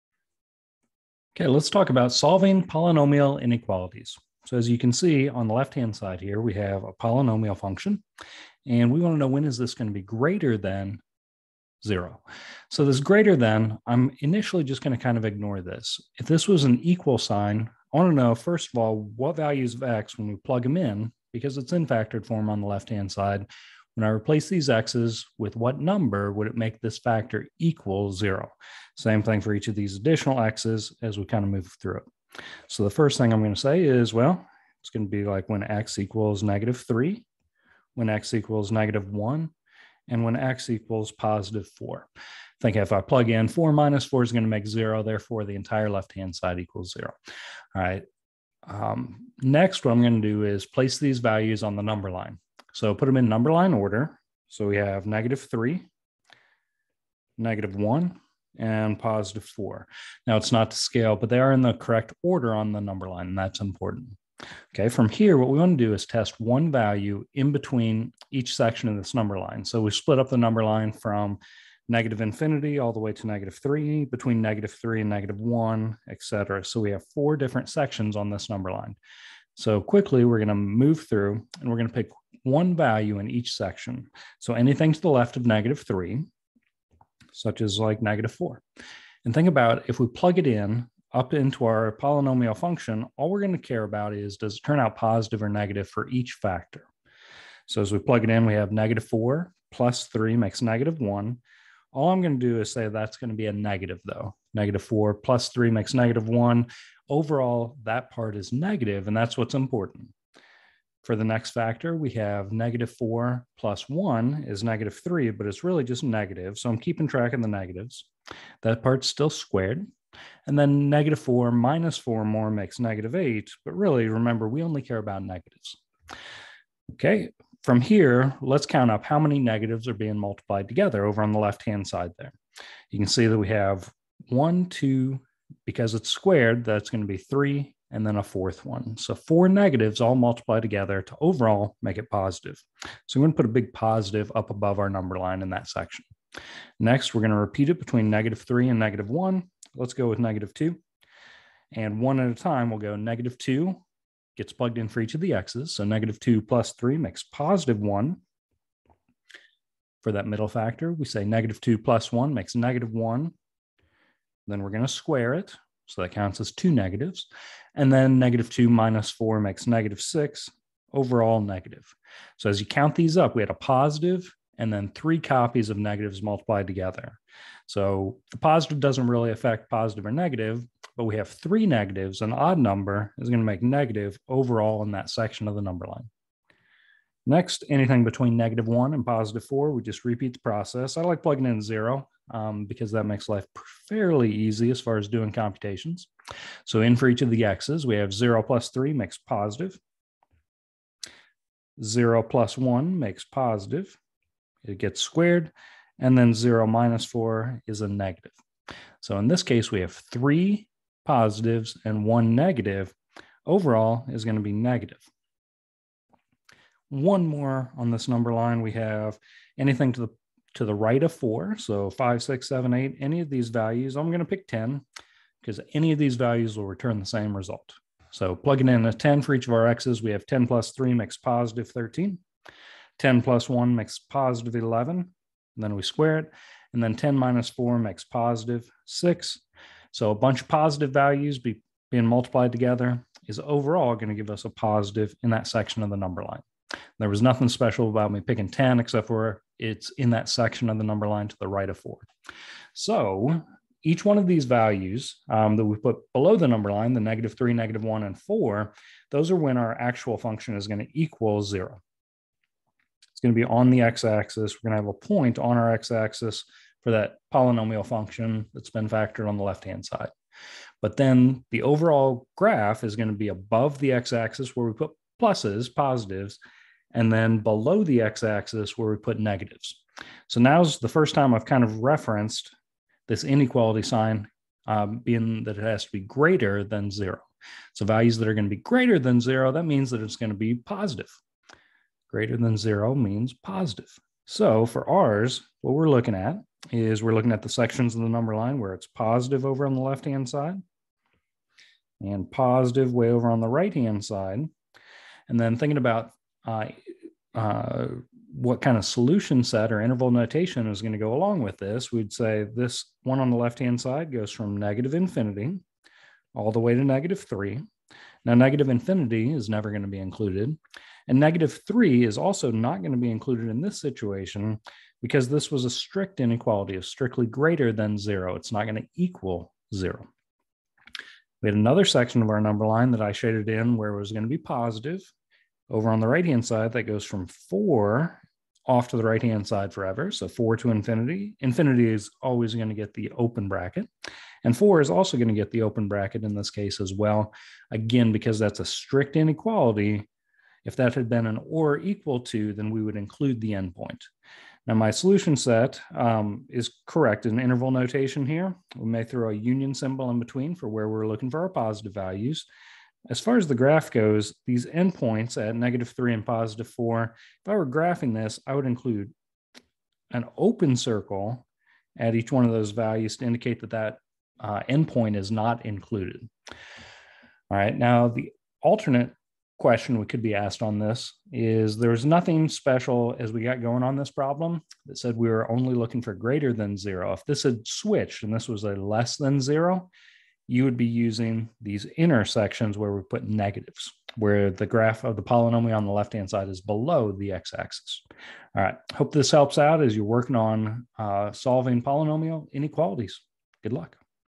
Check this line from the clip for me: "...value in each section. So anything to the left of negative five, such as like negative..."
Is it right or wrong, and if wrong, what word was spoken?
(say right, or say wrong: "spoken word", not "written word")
wrong: "three", not "five".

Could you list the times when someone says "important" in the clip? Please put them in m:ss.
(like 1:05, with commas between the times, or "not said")
1:03, 1:49.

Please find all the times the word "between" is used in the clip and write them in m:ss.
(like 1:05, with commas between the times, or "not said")
1:07, 1:14, 2:27, 3:08, 6:00.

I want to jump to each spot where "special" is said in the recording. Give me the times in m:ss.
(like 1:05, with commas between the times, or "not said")
4:07, 6:22.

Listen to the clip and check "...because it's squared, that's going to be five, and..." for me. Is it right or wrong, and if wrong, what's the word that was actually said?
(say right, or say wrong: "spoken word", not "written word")
wrong: "three", not "five".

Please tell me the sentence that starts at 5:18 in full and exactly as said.
Now, negative infinity is never going to be included.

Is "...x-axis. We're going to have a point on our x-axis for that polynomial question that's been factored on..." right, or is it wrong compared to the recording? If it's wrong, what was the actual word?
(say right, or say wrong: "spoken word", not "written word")
wrong: "function", not "question".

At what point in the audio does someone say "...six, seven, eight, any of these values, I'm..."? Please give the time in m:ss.
3:42.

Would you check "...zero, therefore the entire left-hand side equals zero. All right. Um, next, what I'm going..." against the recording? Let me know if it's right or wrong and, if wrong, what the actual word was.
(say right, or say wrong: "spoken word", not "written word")
right.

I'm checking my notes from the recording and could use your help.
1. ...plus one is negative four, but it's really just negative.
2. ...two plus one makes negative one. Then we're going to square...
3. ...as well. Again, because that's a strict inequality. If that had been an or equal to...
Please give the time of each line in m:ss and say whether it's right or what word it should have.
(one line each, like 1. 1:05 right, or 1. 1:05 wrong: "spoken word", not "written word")
1. 1:53 wrong: "three", not "four"
2. 2:41 right
3. 5:46 right.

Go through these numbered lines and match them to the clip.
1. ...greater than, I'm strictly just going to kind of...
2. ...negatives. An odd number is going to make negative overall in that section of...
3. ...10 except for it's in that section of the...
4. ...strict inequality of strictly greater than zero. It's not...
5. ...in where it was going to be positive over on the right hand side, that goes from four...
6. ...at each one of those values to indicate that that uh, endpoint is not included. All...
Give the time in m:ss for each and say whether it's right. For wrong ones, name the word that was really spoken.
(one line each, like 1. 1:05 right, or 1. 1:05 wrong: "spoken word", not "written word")
1. 0:12 wrong: "initially", not "strictly"
2. 3:01 right
3. 4:08 right
4. 5:25 right
5. 5:33 right
6. 6:11 right.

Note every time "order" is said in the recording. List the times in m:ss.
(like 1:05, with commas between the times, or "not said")
0:53, 1:02.